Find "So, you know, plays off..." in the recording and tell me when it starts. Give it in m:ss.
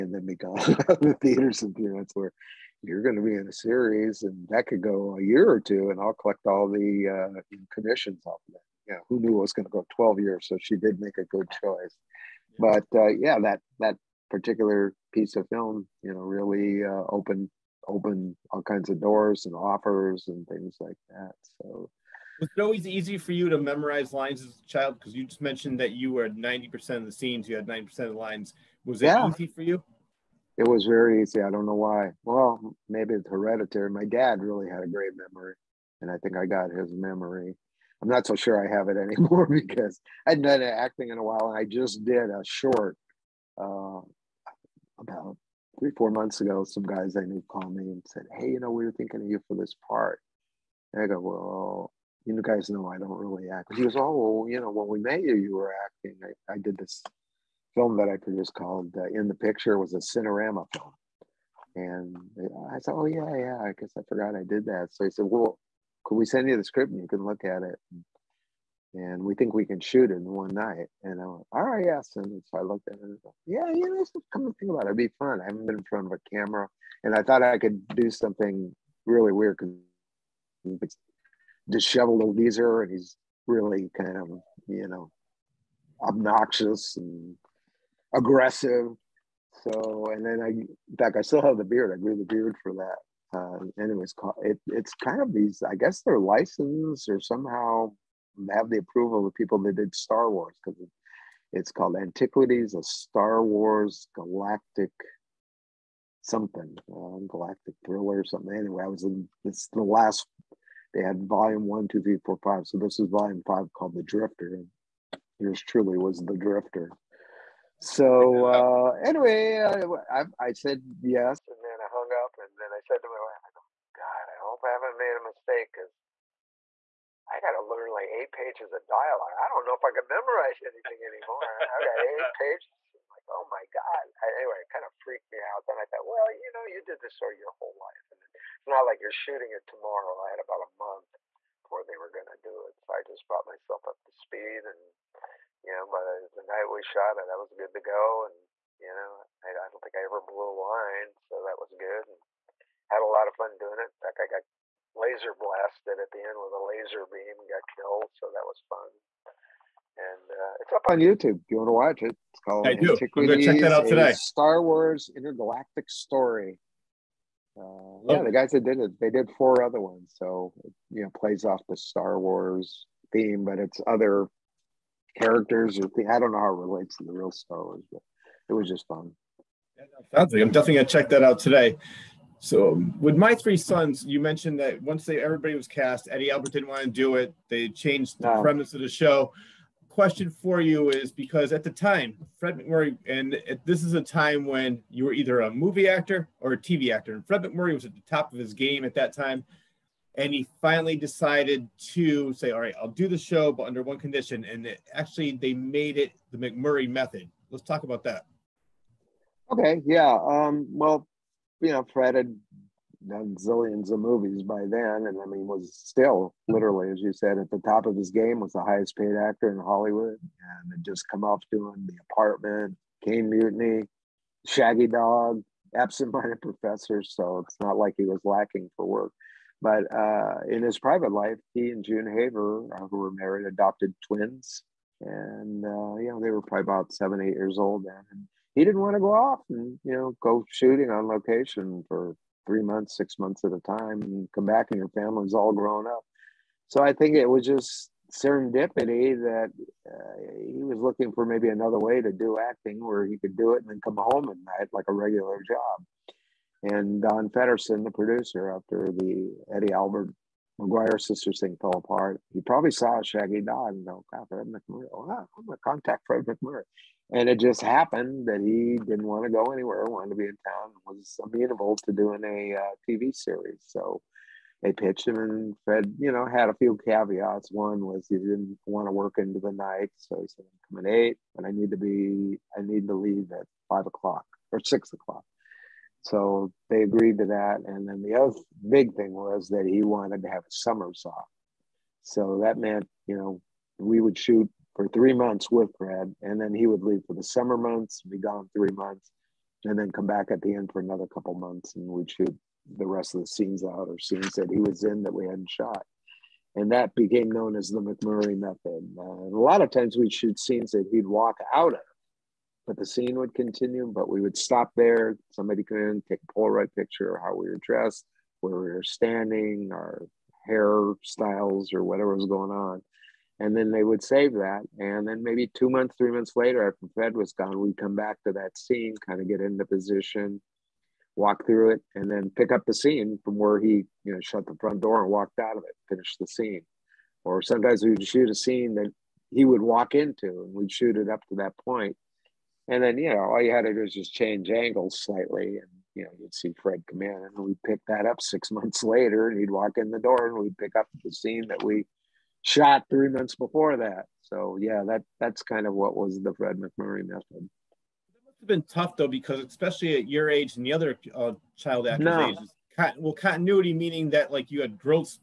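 2:50.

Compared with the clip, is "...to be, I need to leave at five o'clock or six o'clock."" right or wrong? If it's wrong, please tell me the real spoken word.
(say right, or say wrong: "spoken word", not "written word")
right.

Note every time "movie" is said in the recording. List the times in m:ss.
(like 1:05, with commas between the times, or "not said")
3:15, 3:33.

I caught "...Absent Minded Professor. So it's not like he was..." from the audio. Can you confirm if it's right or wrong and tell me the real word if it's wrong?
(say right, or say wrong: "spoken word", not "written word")
right.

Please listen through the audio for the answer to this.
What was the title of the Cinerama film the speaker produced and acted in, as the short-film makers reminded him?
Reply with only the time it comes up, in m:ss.
0:59.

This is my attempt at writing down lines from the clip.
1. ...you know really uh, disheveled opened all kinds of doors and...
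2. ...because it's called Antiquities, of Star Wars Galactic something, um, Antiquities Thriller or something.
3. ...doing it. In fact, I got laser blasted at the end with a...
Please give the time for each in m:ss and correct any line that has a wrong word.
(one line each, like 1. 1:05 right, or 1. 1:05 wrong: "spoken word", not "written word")
1. 0:16 wrong: "opened", not "disheveled"
2. 1:40 wrong: "Galactic", not "Antiquities"
3. 2:33 right.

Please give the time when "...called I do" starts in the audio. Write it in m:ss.
2:42.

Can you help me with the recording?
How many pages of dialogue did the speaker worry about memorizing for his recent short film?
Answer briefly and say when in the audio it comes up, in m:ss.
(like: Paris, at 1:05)
8, at 2:08.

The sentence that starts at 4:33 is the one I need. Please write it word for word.
So they pitched him, and Fred, you know, had a few caveats.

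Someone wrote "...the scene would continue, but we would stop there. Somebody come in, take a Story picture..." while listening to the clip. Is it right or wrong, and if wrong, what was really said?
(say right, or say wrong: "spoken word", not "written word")
wrong: "Polaroid", not "Story".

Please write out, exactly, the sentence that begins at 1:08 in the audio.
And we think we can shoot it in one night.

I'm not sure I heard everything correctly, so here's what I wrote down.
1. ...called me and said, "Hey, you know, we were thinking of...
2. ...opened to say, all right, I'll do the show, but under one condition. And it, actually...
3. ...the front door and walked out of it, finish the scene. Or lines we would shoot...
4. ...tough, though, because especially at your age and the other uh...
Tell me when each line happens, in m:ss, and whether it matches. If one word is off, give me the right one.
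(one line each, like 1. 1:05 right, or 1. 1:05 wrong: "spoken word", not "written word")
1. 0:47 right
2. 3:20 wrong: "decided", not "opened"
3. 5:34 wrong: "sometimes", not "lines"
4. 5:58 right.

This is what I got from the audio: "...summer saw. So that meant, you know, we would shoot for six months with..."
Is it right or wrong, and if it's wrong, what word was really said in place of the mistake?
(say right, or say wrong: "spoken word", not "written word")
wrong: "three", not "six".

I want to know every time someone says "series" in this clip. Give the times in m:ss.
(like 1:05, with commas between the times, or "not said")
0:03, 4:33.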